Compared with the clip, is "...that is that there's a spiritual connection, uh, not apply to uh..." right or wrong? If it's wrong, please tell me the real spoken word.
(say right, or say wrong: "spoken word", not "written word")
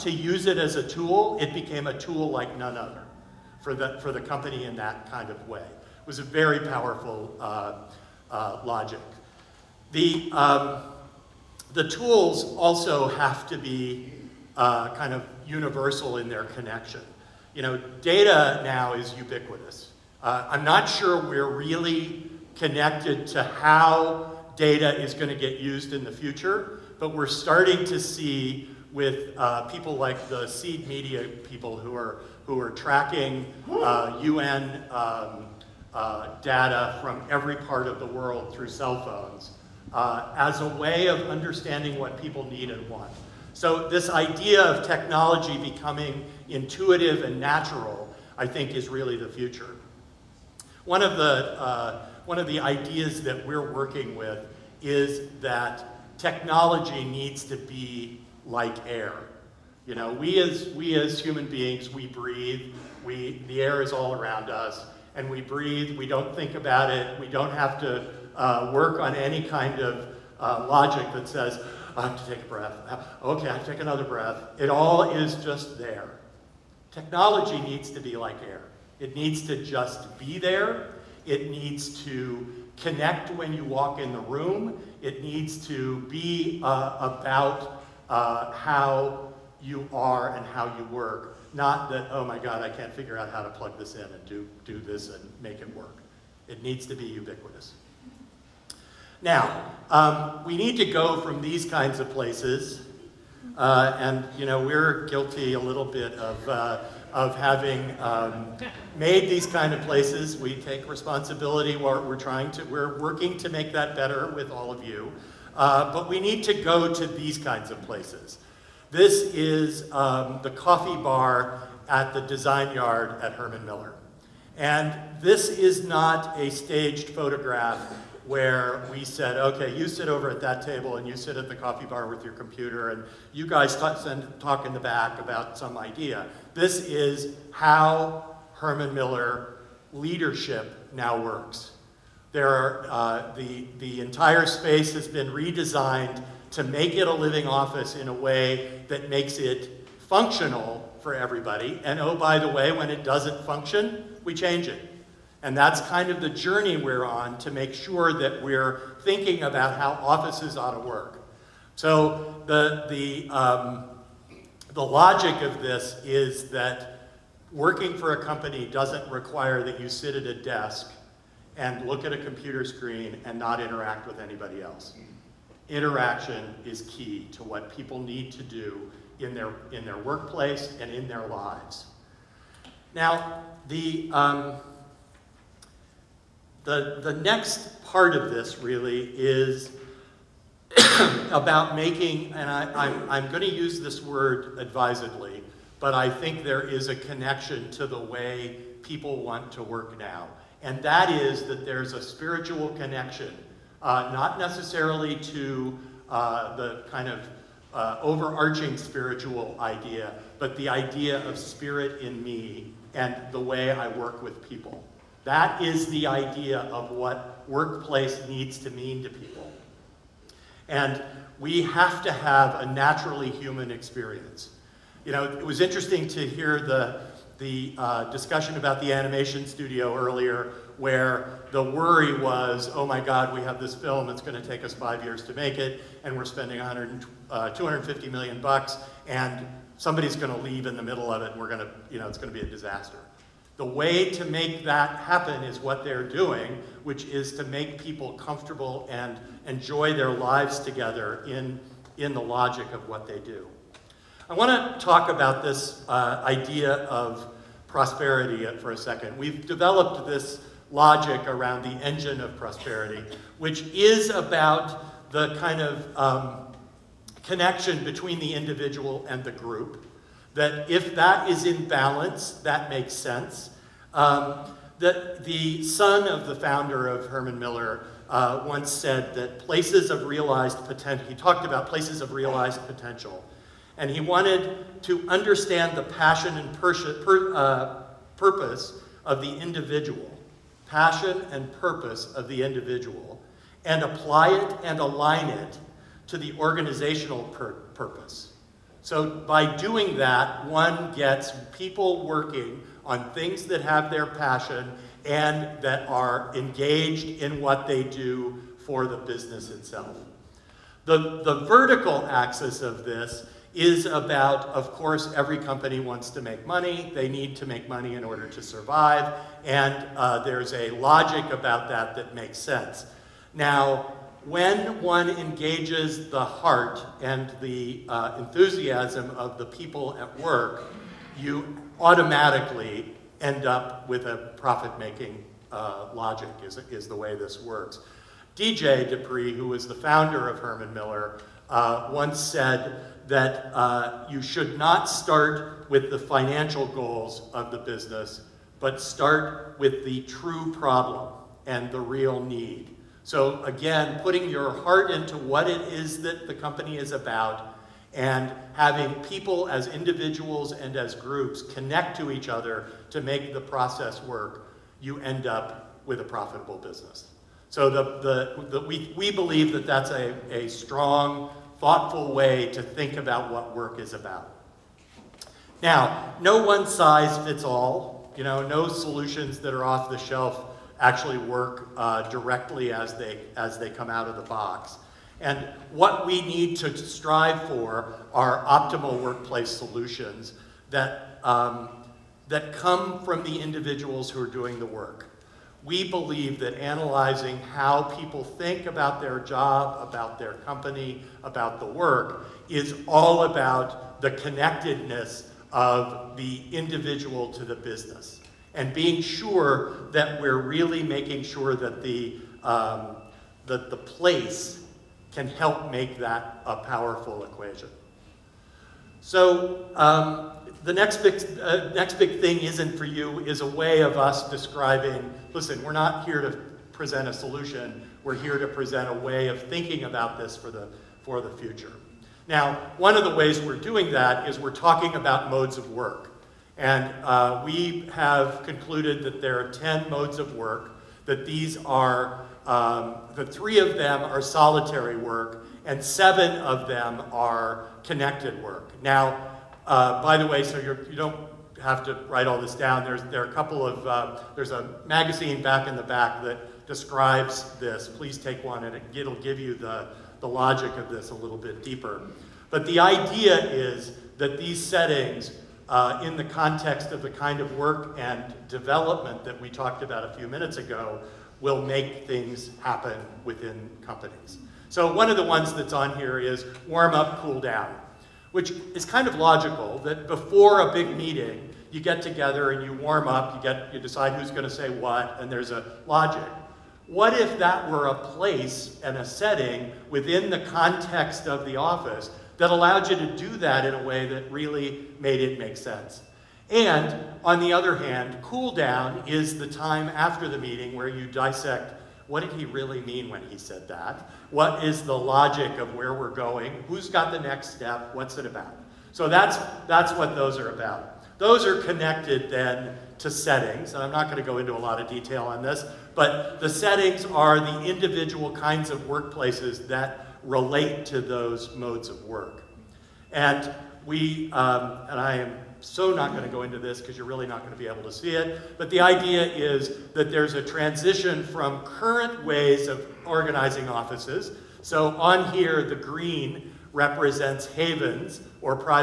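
wrong: "necessarily", not "apply".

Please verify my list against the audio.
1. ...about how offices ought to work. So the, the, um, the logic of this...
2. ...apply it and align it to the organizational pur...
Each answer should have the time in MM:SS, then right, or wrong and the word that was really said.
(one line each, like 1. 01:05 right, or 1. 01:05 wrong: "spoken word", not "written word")
1. 02:39 right
2. 04:53 right.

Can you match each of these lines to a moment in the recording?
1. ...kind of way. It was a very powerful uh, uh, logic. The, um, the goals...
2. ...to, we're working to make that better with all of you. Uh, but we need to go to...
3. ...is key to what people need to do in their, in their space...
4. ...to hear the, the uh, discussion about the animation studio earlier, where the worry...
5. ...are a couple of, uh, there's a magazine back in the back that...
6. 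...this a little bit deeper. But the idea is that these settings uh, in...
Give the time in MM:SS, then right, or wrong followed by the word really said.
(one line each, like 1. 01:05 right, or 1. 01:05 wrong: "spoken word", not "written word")
1. 00:05 wrong: "tools", not "goals"
2. 01:52 right
3. 02:56 wrong: "workplace", not "space"
4. 03:46 right
5. 07:33 right
6. 07:40 right.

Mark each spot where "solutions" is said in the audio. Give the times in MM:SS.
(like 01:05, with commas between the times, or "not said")
06:18, 06:29, 07:07.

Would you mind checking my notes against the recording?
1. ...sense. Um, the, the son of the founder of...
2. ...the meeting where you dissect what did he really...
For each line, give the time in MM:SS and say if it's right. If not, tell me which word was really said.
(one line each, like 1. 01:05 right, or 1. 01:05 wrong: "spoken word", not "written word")
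1. 04:32 right
2. 08:20 right.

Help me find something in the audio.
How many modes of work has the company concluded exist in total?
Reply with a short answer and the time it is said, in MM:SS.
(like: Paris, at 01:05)
10, at 07:19.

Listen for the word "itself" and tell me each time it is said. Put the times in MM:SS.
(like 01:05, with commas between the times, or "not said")
05:09.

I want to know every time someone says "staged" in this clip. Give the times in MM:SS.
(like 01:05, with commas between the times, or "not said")
02:06.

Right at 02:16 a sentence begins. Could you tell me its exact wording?
This is how Herman Miller leadership now works.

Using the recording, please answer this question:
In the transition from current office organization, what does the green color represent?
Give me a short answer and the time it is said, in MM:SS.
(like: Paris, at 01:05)
havens, at 08:55.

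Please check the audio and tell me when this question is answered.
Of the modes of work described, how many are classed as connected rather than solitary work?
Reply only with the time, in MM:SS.
07:25.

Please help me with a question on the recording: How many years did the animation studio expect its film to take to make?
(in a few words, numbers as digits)
5.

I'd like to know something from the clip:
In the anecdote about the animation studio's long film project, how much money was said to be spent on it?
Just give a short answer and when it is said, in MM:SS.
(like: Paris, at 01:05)
250 million, at 03:57.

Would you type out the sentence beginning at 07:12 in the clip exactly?
Now, one of the ways we're doing that is we're talking about modes of work.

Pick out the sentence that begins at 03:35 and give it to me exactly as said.
That is the idea of what workplace needs to mean to people.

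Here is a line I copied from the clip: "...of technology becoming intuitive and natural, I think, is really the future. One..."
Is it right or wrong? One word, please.
right.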